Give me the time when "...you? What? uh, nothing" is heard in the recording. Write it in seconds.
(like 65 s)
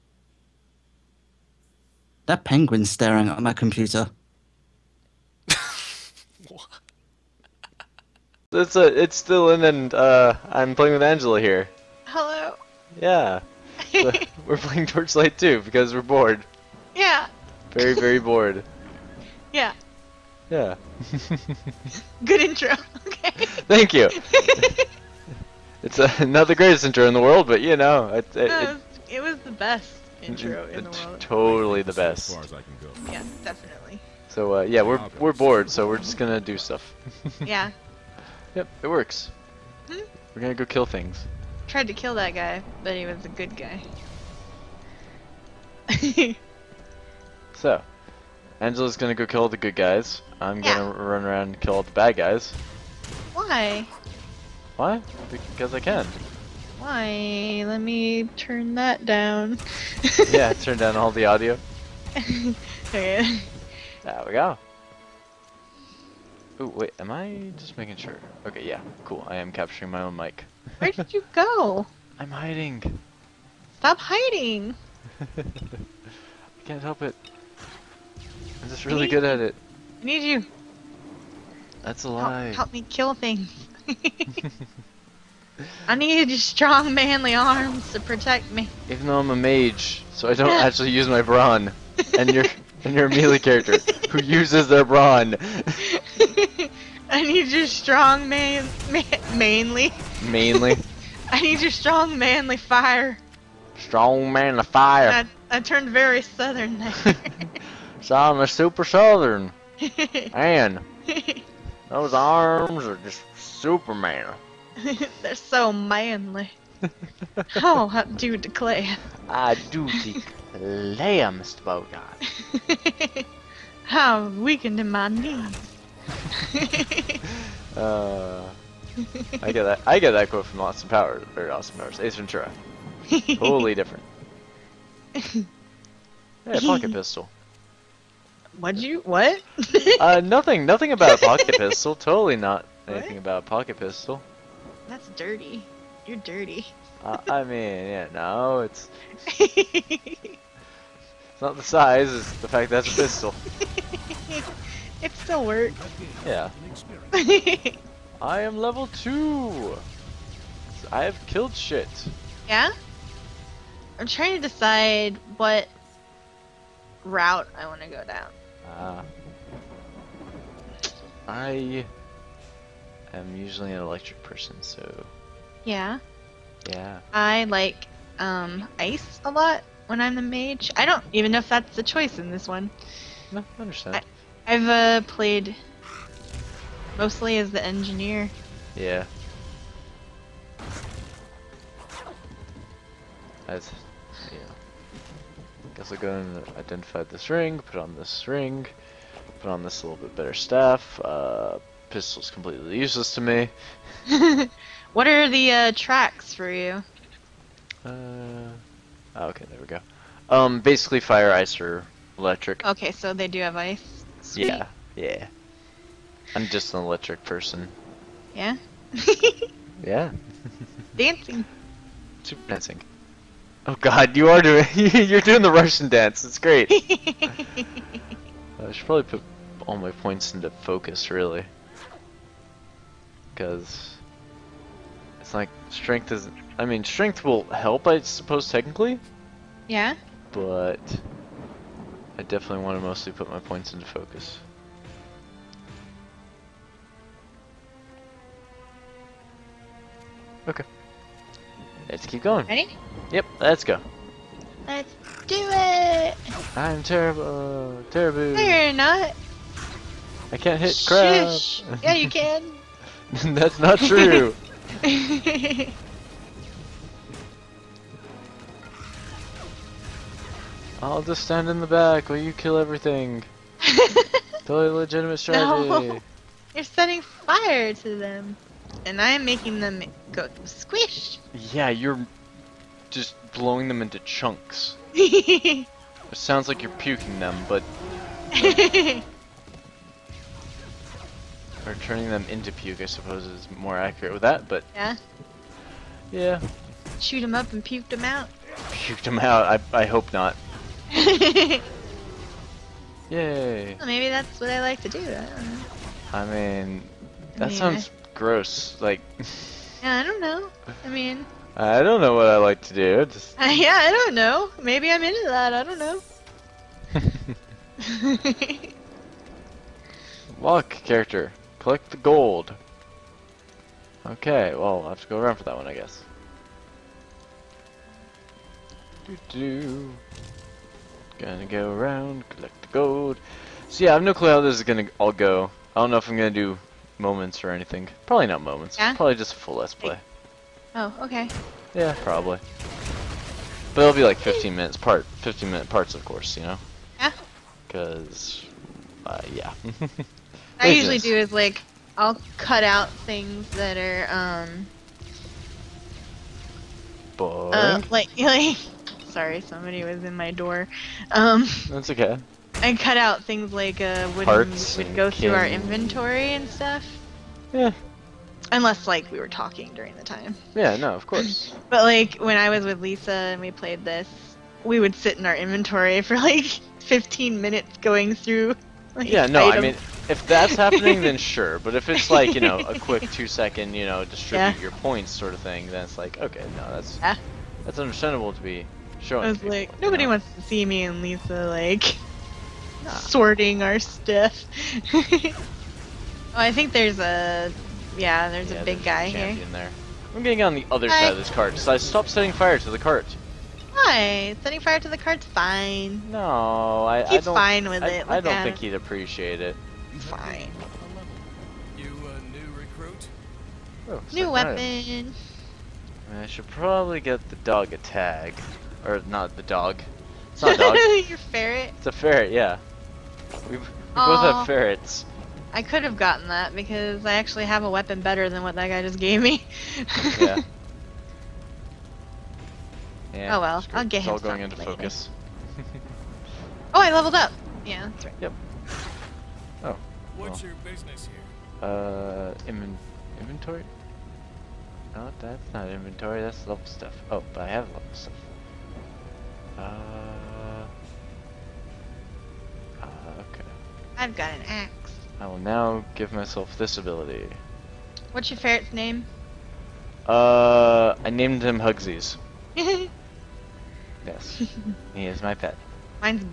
138 s.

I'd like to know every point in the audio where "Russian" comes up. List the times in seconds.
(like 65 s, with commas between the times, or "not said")
225 s.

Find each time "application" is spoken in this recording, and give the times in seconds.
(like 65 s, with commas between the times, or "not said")
not said.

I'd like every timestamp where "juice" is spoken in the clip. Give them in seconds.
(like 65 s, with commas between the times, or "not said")
not said.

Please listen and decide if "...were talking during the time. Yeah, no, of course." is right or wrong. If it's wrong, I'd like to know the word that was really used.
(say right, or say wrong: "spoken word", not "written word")
right.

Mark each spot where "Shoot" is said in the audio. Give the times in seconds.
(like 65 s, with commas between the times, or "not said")
296 s.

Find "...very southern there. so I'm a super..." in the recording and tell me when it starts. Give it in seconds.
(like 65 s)
105 s.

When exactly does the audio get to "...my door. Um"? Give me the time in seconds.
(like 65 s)
360 s.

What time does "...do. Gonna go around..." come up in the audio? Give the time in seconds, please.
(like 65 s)
329 s.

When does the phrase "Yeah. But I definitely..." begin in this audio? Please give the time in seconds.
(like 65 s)
239 s.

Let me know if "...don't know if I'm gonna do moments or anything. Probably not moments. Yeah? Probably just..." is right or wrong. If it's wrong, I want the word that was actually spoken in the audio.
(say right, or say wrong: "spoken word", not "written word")
right.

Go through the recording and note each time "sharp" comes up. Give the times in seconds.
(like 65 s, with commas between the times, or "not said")
not said.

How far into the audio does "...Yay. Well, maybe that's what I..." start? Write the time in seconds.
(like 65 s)
303 s.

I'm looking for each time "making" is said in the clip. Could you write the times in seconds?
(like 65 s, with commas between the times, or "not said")
67 s, 279 s.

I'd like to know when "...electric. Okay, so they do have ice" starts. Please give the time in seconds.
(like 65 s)
212 s.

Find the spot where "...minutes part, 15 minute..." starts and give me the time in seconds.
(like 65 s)
344 s.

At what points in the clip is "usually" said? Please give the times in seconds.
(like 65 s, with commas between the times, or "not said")
173 s, 350 s.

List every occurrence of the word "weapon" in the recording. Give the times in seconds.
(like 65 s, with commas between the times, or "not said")
414 s, 427 s.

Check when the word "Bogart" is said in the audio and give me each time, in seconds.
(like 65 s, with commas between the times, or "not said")
121 s.